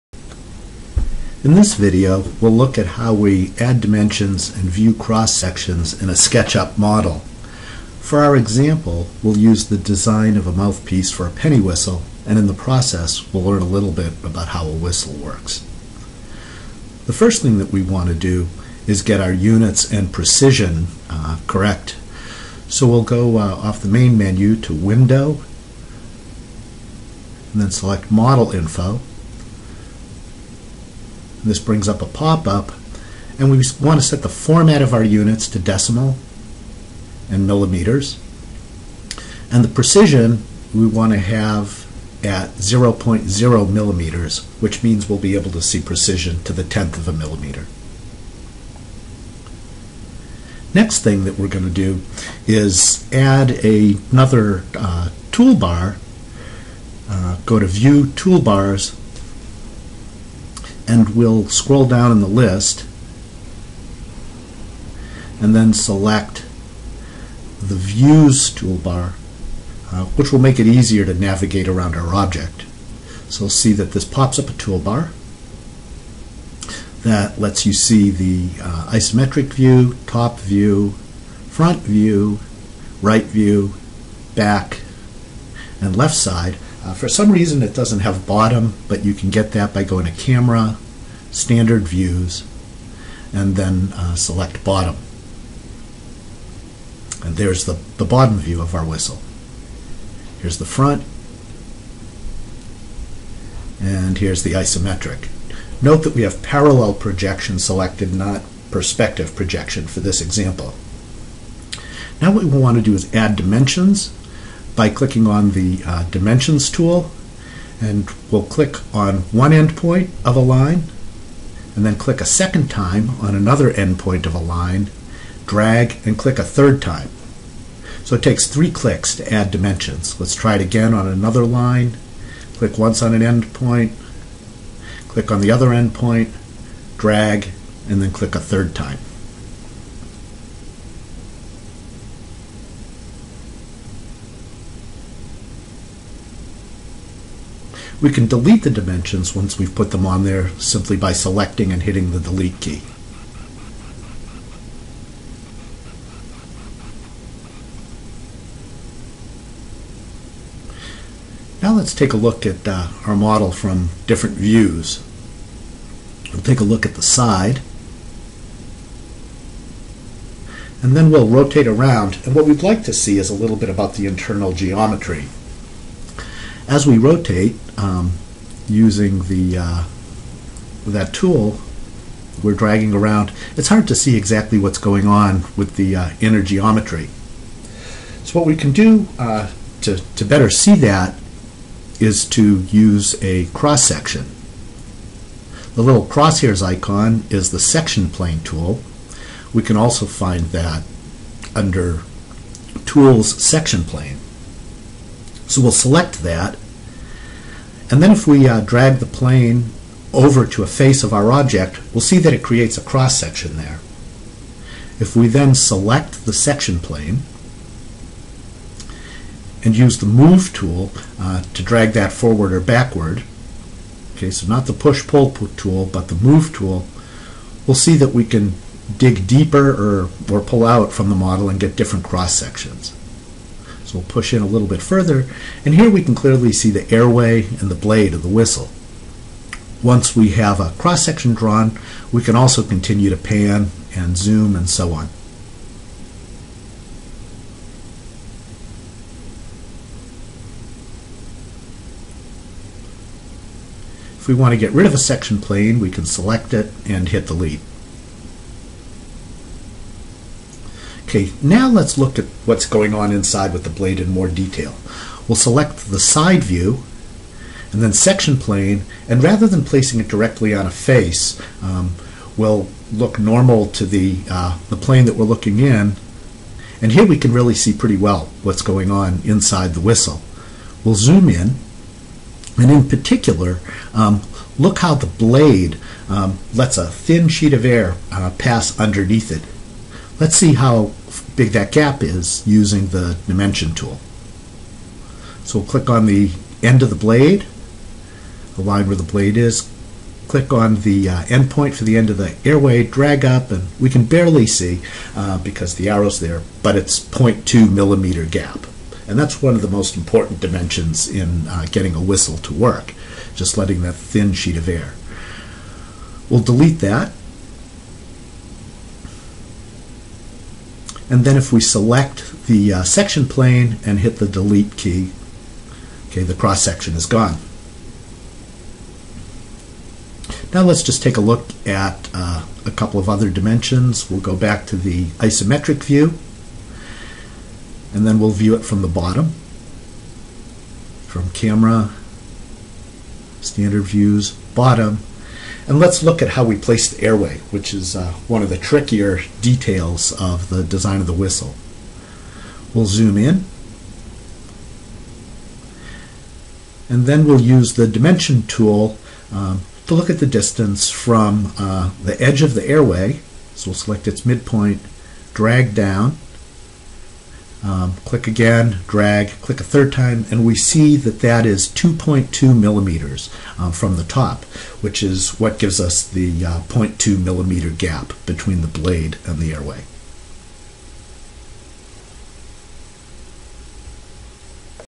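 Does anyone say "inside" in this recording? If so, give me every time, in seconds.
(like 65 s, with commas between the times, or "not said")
263 s, 279 s.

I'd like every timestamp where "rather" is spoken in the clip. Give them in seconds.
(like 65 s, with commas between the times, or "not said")
269 s.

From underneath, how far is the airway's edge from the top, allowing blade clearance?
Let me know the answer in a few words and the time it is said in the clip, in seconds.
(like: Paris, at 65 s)
2.2 millimeters, at 371 s.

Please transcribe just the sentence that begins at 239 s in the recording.
Once we have a cross-section drawn, we can also continue to pan and zoom and so on.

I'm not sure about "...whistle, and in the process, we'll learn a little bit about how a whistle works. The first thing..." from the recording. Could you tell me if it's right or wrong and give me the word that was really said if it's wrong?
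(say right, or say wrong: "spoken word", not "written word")
right.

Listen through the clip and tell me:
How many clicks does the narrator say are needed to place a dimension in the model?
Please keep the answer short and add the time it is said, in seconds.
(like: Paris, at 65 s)
3, at 128 s.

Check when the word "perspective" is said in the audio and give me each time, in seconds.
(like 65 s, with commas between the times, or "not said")
108 s.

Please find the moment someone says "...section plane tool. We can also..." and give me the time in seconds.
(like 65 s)
197 s.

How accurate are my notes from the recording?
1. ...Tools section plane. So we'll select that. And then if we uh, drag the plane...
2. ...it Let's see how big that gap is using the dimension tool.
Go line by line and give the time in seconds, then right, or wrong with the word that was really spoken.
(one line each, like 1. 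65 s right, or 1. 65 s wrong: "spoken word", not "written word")
1. 202 s right
2. 289 s right.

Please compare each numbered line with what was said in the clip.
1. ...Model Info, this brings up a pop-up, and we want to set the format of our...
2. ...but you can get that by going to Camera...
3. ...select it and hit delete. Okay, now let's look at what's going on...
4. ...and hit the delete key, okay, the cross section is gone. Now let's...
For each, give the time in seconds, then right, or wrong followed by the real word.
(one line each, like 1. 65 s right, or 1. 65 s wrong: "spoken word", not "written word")
1. 28 s right
2. 88 s right
3. 256 s right
4. 323 s right.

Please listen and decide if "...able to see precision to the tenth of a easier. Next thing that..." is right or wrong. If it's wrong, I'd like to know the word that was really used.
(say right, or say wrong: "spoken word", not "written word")
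wrong: "millimeter", not "easier".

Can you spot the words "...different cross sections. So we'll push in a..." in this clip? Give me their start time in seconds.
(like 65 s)
231 s.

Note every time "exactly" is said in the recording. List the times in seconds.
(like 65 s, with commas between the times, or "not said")
184 s.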